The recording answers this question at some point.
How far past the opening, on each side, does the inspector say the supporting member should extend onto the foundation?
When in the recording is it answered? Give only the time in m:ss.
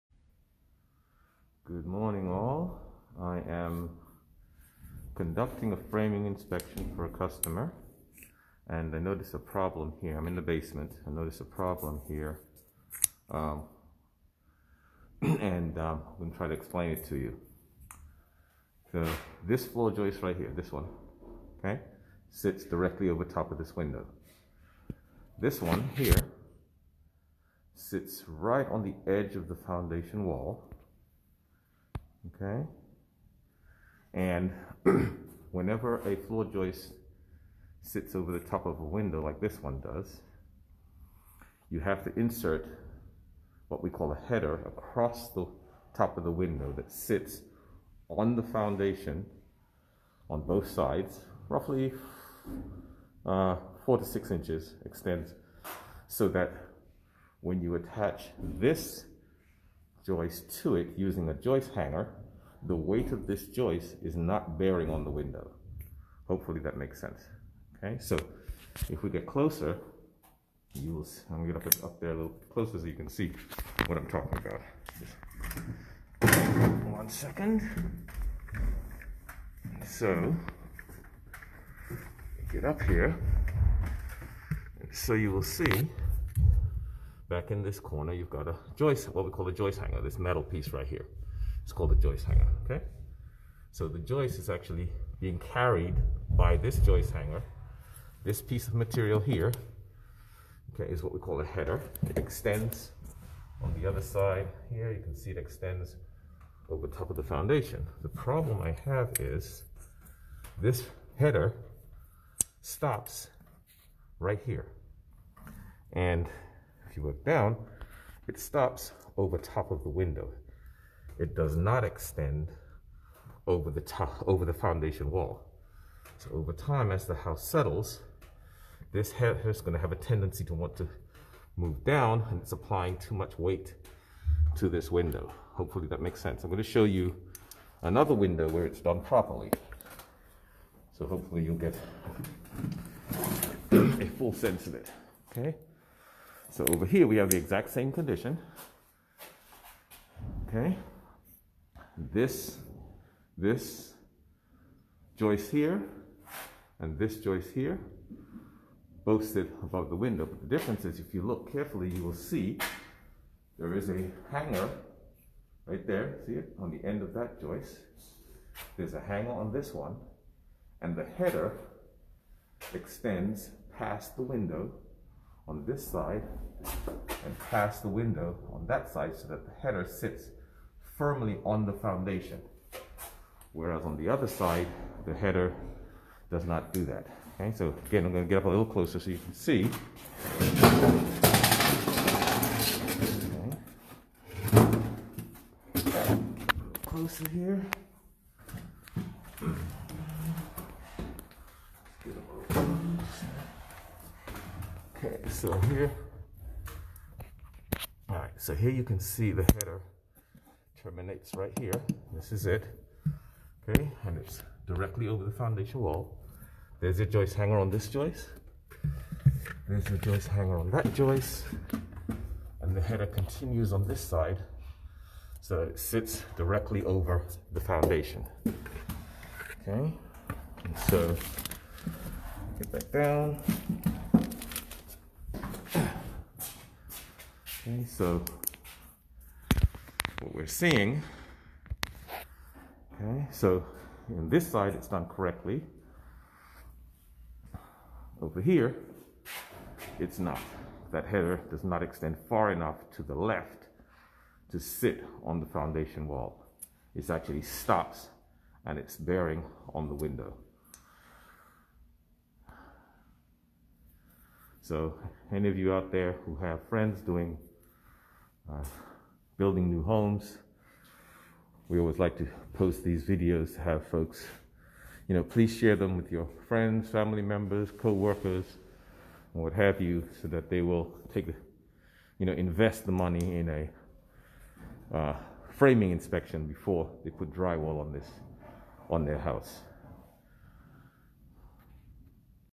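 0:53.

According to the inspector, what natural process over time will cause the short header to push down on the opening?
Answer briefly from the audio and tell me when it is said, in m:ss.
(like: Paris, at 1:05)
house settles, at 2:06.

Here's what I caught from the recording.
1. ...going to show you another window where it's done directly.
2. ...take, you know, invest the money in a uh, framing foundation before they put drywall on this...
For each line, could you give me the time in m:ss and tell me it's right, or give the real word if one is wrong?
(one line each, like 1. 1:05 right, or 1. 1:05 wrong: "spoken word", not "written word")
1. 2:16 wrong: "properly", not "directly"
2. 4:41 wrong: "inspection", not "foundation".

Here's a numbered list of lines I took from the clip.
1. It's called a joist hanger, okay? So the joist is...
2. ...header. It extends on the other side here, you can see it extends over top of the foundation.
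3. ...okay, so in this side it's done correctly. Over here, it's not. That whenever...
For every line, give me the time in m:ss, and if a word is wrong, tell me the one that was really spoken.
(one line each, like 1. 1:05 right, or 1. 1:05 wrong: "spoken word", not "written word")
1. 1:31 right
2. 1:41 right
3. 4:02 wrong: "header", not "whenever".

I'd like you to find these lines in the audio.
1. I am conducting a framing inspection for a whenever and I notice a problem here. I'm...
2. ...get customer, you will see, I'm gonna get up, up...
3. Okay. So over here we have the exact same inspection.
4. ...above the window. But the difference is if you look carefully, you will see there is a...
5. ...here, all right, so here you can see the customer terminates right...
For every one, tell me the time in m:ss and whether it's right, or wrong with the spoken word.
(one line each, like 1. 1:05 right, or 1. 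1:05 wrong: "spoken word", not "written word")
1. 0:03 wrong: "customer", not "whenever"
2. 1:09 wrong: "closer", not "customer"
3. 2:25 wrong: "condition", not "inspection"
4. 2:39 right
5. 3:25 wrong: "header", not "customer".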